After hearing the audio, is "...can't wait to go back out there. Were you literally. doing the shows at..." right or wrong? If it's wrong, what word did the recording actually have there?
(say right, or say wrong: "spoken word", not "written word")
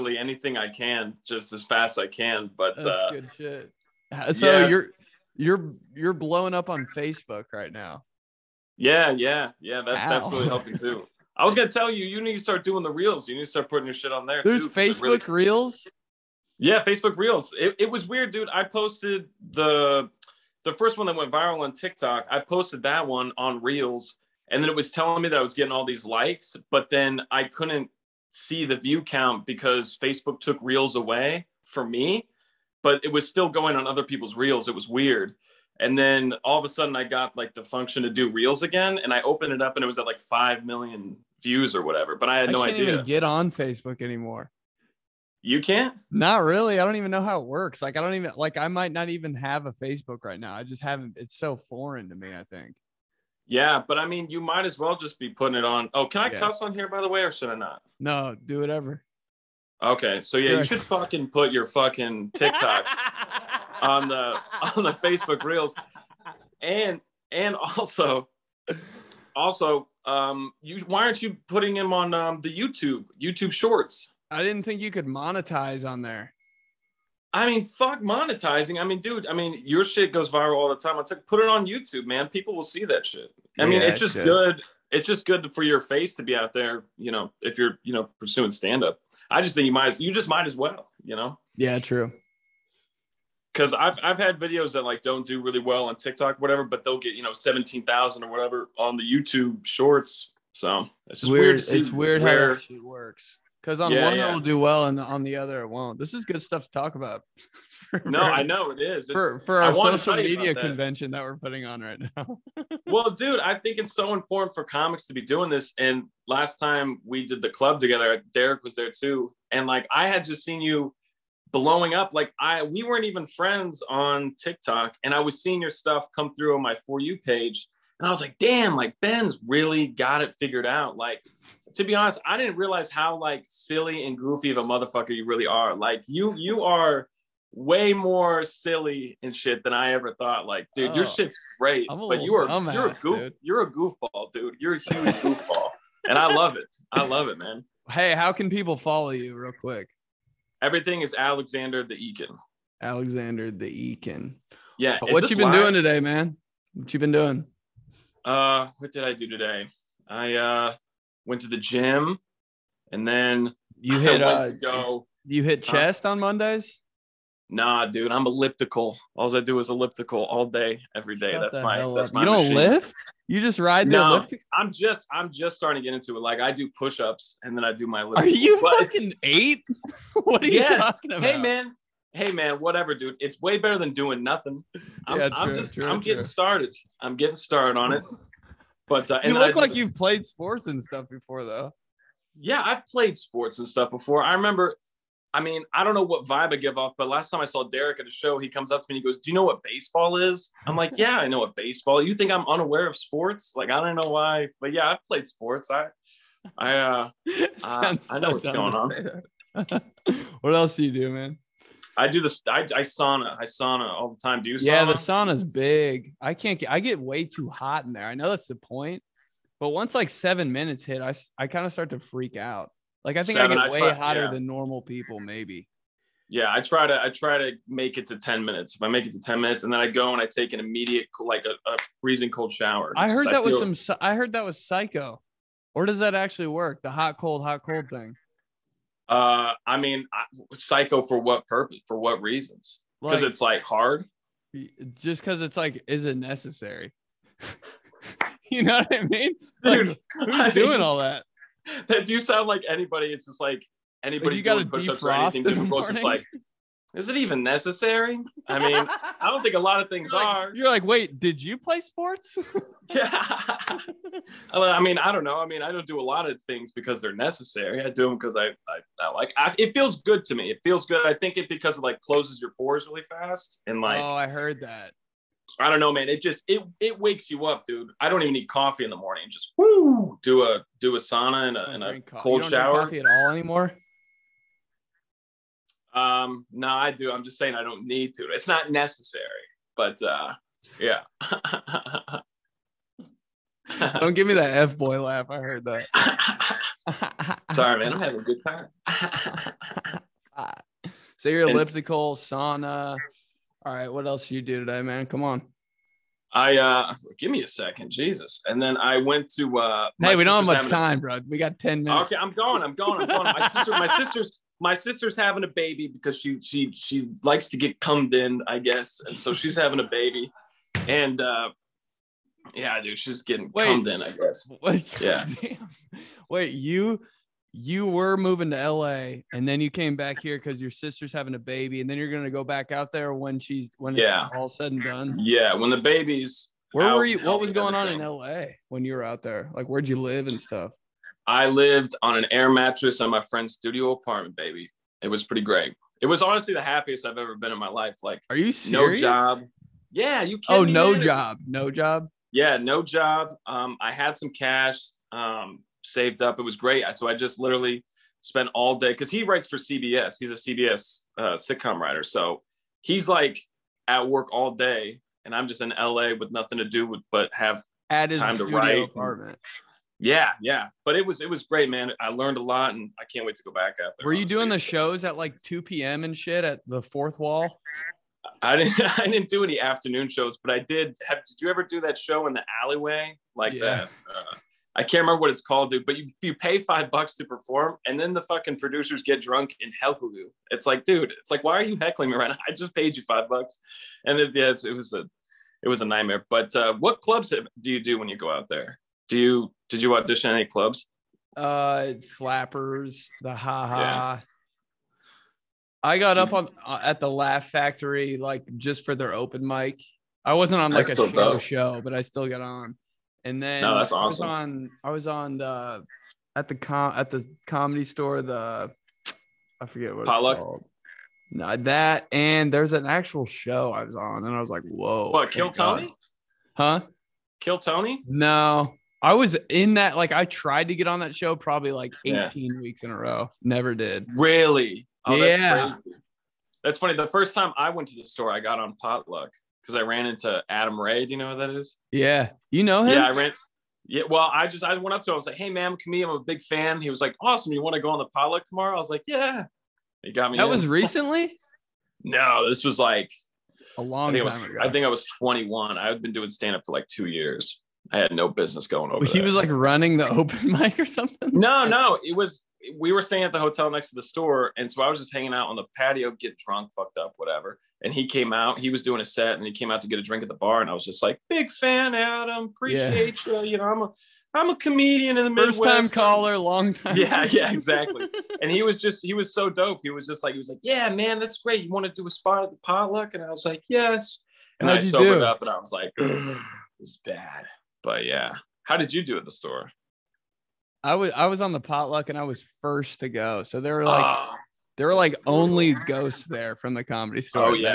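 wrong: "honestly", not "literally".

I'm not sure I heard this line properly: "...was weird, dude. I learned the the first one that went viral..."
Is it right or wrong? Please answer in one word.
wrong.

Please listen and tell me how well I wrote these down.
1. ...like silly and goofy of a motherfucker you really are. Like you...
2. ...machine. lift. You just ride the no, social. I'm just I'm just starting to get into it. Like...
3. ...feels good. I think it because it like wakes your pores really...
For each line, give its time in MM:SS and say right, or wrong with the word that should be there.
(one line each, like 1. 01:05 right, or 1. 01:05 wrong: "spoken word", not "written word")
1. 02:13 right
2. 02:52 wrong: "elliptical", not "social"
3. 04:30 wrong: "closes", not "wakes".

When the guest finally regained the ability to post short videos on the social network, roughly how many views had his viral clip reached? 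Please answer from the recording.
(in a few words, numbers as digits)
5 million.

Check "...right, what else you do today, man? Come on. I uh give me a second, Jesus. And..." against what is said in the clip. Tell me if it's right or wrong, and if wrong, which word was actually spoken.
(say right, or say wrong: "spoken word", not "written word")
right.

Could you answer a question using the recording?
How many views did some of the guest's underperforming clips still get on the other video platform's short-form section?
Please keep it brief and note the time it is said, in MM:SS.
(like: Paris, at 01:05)
17,000, at 01:37.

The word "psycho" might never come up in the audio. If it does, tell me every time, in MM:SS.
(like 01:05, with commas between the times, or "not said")
03:54, 04:00.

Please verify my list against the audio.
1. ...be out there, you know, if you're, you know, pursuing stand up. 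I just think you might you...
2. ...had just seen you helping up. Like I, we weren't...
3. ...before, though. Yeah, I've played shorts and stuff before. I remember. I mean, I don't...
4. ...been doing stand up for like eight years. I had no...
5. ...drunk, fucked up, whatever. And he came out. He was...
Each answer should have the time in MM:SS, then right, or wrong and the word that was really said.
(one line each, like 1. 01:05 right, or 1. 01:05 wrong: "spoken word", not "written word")
1. 01:26 right
2. 02:00 wrong: "blowing", not "helping"
3. 03:11 wrong: "sports", not "shorts"
4. 07:36 wrong: "two", not "eight"
5. 07:46 right.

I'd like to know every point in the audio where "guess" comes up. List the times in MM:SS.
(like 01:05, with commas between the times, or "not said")
05:18, 05:24.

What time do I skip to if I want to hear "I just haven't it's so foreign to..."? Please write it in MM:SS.
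00:50.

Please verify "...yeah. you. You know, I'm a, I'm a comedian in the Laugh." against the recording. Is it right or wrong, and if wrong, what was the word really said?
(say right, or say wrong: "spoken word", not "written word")
wrong: "Midwest", not "Laugh".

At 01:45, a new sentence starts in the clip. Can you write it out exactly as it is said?
This is good stuff to talk about.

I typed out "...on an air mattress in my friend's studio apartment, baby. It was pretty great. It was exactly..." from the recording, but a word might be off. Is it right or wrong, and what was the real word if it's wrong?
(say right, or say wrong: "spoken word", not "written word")
wrong: "honestly", not "exactly".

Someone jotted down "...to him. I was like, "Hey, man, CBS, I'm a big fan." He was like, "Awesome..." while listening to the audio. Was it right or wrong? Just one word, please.
wrong.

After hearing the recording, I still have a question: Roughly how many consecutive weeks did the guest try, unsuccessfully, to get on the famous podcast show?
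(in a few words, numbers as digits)
18.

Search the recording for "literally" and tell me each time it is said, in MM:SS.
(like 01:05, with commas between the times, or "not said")
05:57.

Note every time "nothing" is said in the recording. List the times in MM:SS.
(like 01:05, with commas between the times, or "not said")
03:04, 06:06.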